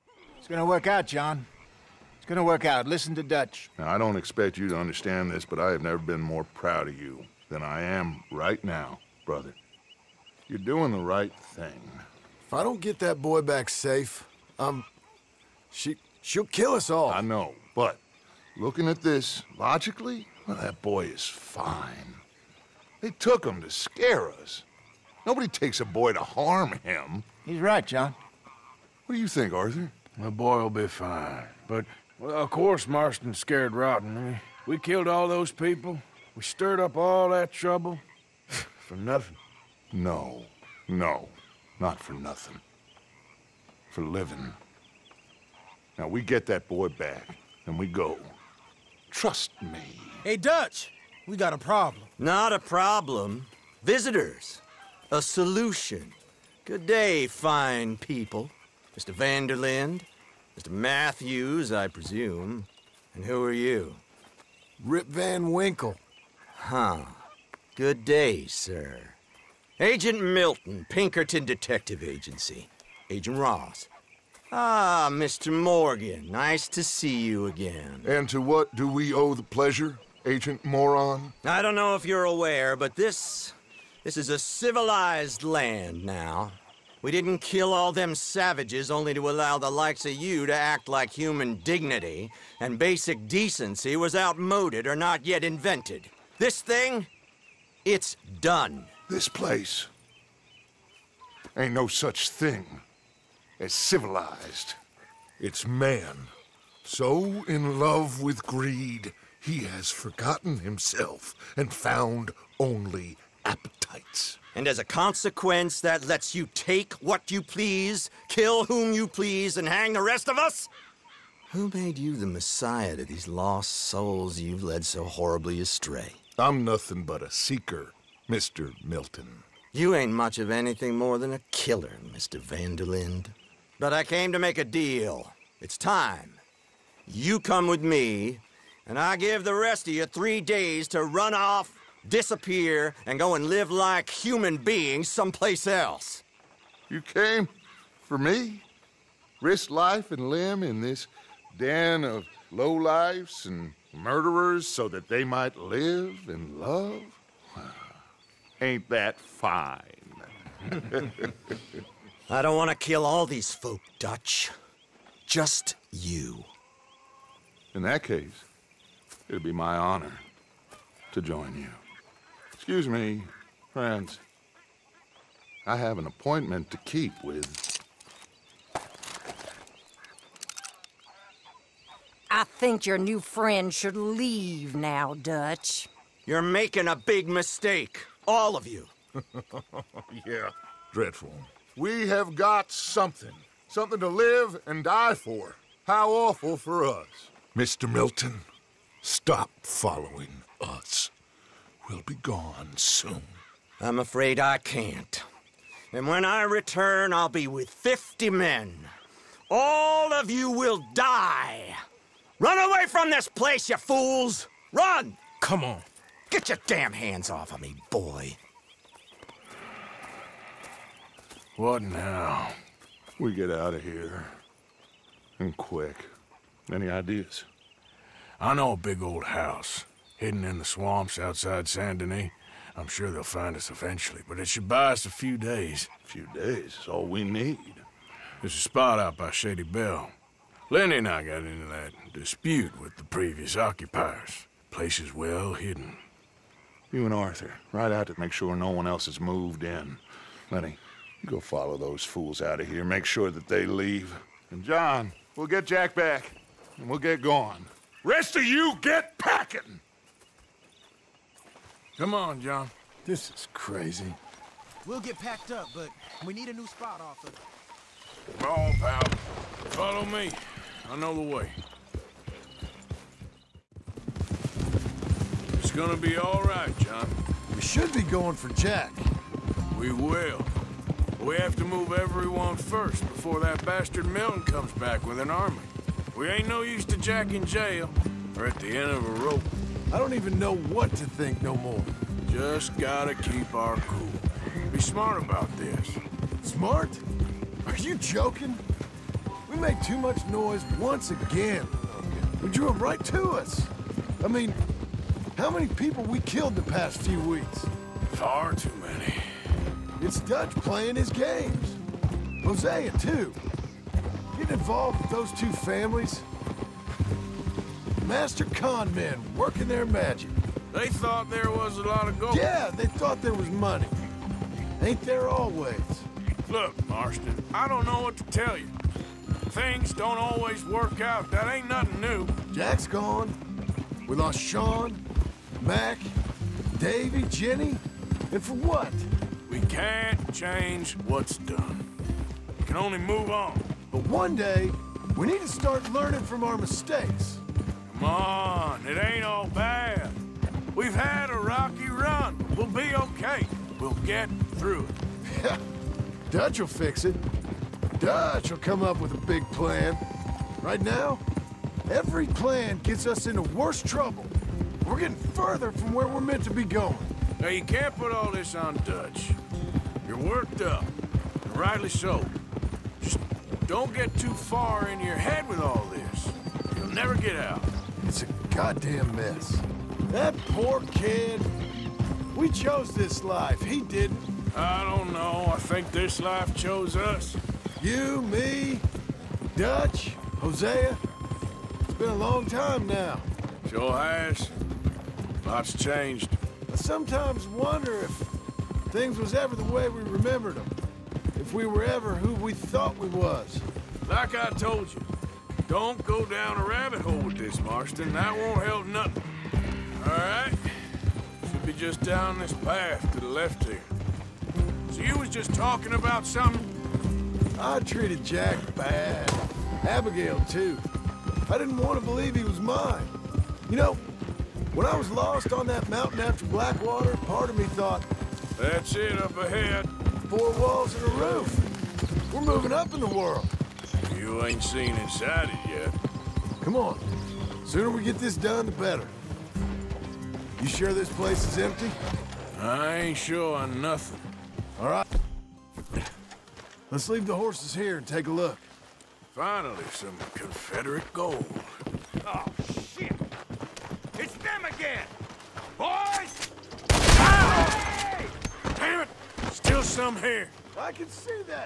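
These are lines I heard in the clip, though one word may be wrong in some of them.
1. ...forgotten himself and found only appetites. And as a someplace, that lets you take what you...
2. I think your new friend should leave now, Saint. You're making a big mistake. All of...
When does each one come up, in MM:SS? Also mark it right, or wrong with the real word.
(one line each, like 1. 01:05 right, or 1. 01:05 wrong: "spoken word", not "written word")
1. 01:49 wrong: "consequence", not "someplace"
2. 03:02 wrong: "Dutch", not "Saint".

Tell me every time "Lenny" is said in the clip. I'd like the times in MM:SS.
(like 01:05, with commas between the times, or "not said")
04:00, 04:10.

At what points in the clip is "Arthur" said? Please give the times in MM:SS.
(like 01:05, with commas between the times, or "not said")
00:29, 04:07.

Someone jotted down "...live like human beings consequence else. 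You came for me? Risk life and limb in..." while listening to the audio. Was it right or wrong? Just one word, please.
wrong.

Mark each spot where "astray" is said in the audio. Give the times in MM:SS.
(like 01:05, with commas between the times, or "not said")
02:05.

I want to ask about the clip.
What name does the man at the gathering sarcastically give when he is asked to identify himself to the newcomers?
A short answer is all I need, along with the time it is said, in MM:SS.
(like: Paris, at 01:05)
Rip Van Winkle, at 01:04.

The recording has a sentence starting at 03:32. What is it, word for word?
Run away from this place, you fools!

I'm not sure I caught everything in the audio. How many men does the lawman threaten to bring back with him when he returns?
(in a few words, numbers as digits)
50.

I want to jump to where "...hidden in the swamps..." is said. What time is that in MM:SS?
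03:50.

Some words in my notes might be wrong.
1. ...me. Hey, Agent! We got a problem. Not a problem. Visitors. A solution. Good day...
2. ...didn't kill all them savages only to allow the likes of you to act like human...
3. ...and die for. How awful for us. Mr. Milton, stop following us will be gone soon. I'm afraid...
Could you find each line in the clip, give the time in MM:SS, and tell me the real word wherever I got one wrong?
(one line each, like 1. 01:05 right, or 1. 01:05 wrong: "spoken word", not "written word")
1. 00:49 wrong: "Dutch", not "Agent"
2. 01:27 right
3. 03:14 right.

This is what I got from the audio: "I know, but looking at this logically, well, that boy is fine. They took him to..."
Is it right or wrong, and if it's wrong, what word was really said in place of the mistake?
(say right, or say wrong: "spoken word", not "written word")
right.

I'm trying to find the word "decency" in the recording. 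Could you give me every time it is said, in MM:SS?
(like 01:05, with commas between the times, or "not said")
01:33.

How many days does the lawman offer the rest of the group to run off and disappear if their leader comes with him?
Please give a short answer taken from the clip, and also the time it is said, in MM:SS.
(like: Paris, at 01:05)
3, at 02:20.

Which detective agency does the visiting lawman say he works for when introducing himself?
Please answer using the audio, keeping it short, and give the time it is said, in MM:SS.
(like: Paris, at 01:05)
Pinkerton Detective Agency, at 01:10.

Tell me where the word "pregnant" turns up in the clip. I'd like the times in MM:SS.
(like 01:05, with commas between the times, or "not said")
not said.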